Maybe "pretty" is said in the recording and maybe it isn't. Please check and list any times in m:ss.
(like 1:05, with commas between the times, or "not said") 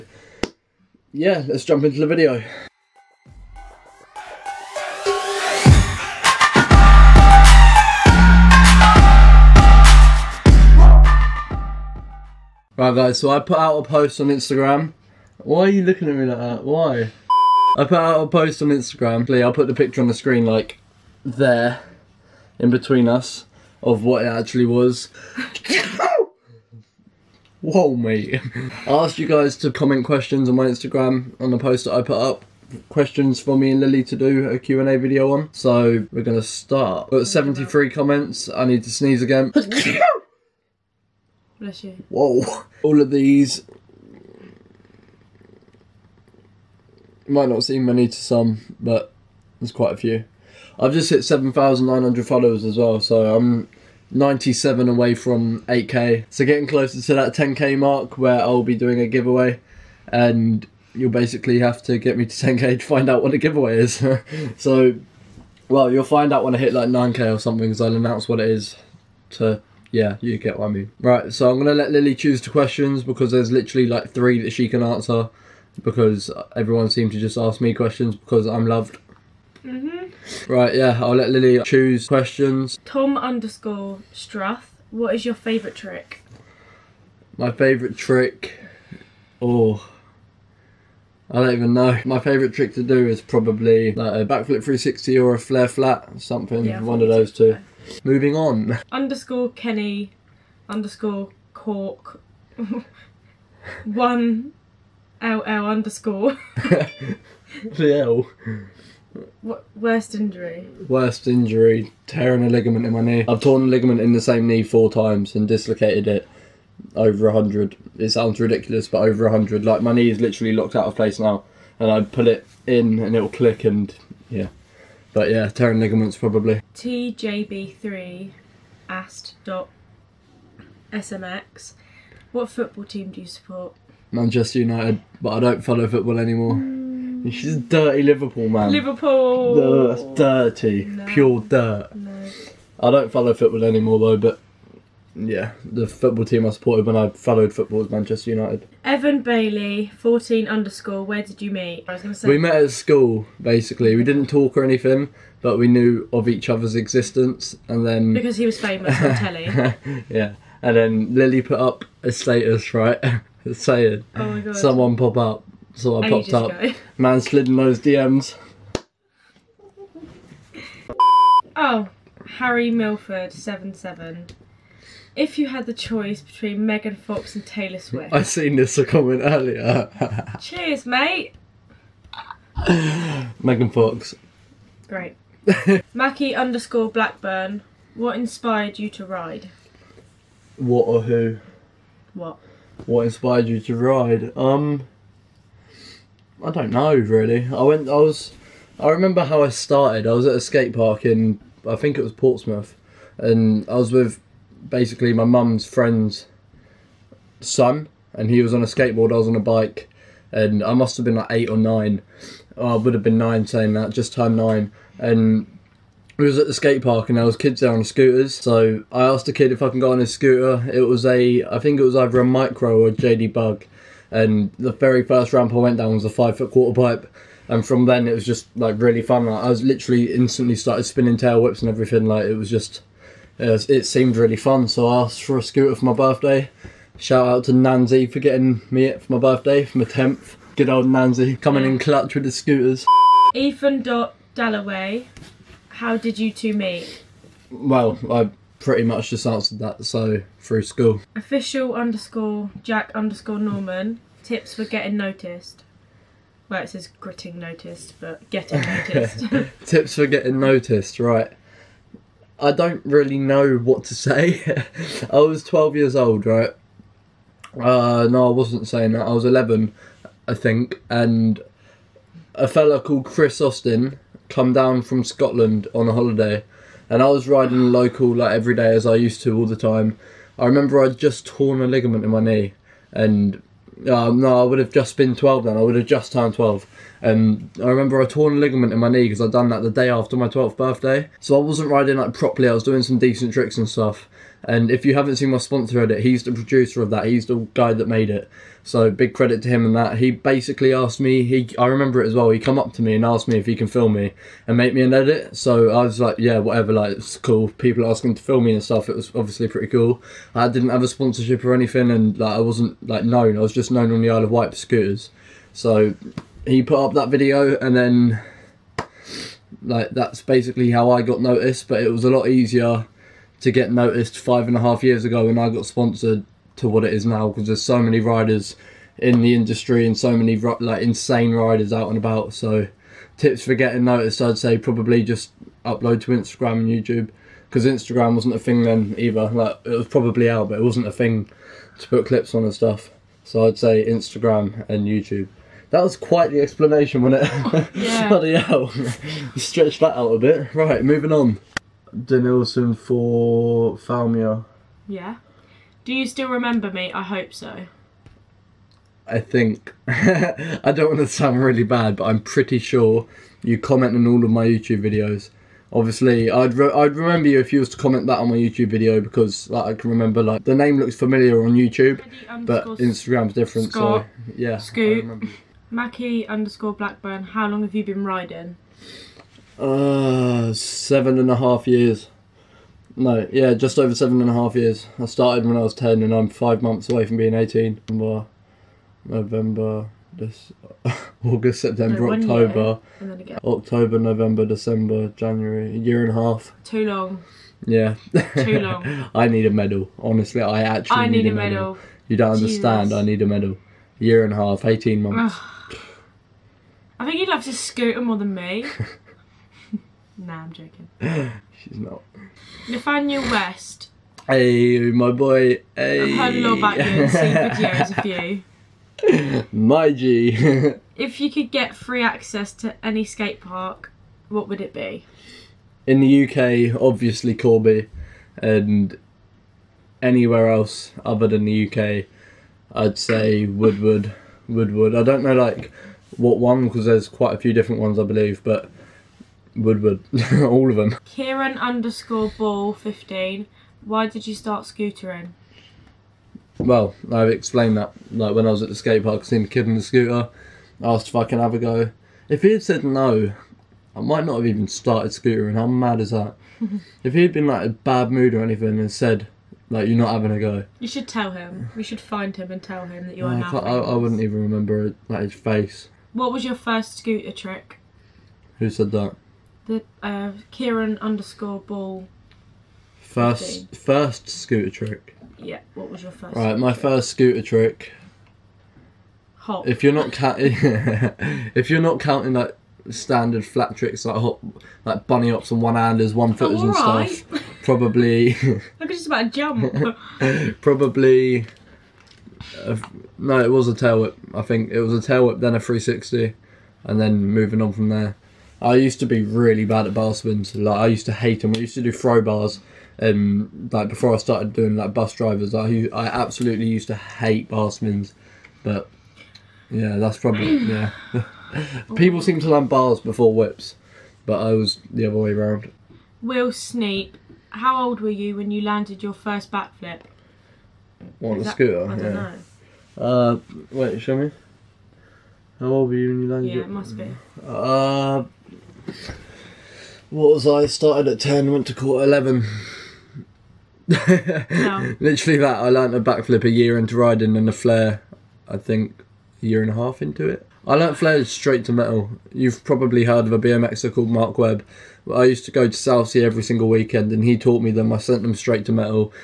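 4:08, 5:09, 6:02.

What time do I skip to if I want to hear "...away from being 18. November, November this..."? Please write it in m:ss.
6:26.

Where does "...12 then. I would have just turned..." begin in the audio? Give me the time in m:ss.
4:45.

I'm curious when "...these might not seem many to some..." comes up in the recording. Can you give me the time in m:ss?
0:43.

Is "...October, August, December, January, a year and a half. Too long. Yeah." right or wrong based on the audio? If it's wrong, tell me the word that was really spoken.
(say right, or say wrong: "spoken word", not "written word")
wrong: "November", not "August".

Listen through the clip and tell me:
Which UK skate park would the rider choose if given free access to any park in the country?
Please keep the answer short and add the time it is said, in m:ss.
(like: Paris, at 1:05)
Corby, at 7:07.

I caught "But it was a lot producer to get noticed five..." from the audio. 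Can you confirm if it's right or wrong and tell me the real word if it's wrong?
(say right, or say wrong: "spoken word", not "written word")
wrong: "easier", not "producer".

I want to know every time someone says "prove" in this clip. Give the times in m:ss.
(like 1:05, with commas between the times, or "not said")
not said.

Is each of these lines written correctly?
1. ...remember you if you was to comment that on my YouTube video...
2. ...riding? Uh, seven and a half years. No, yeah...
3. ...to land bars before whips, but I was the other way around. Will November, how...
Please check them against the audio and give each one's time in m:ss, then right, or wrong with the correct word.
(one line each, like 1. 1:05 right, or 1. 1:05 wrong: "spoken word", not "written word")
1. 6:06 right
2. 6:18 right
3. 8:32 wrong: "Snape", not "November".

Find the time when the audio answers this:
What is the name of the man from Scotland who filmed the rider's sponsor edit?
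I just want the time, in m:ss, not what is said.
4:33.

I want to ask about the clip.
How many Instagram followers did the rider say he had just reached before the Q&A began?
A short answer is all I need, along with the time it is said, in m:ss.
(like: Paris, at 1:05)
7,900, at 0:51.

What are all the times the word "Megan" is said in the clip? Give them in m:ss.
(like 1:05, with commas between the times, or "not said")
2:56, 3:03.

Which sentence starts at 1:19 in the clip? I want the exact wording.
hmm Right, yeah, I'll let Lily choose questions.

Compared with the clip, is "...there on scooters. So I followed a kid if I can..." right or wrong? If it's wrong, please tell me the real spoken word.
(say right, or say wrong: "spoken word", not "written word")
wrong: "asked", not "followed".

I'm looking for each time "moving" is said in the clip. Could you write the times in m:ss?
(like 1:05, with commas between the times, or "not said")
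1:38, 5:50, 8:17.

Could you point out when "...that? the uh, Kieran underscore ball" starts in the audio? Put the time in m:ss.
7:48.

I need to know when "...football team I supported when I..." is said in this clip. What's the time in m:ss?
2:25.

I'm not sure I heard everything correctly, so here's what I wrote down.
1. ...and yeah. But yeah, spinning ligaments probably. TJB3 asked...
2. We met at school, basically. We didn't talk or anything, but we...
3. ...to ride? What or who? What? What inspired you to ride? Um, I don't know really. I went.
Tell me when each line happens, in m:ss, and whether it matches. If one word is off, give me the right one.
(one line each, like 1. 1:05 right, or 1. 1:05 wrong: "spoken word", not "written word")
1. 2:03 wrong: "tearing", not "spinning"
2. 2:32 right
3. 3:08 right.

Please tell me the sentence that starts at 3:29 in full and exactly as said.
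I was on a bike, and I must have been like eight or nine.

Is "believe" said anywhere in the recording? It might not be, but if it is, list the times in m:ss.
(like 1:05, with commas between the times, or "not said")
7:18.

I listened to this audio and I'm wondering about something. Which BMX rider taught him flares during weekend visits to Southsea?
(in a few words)
Mark Webb.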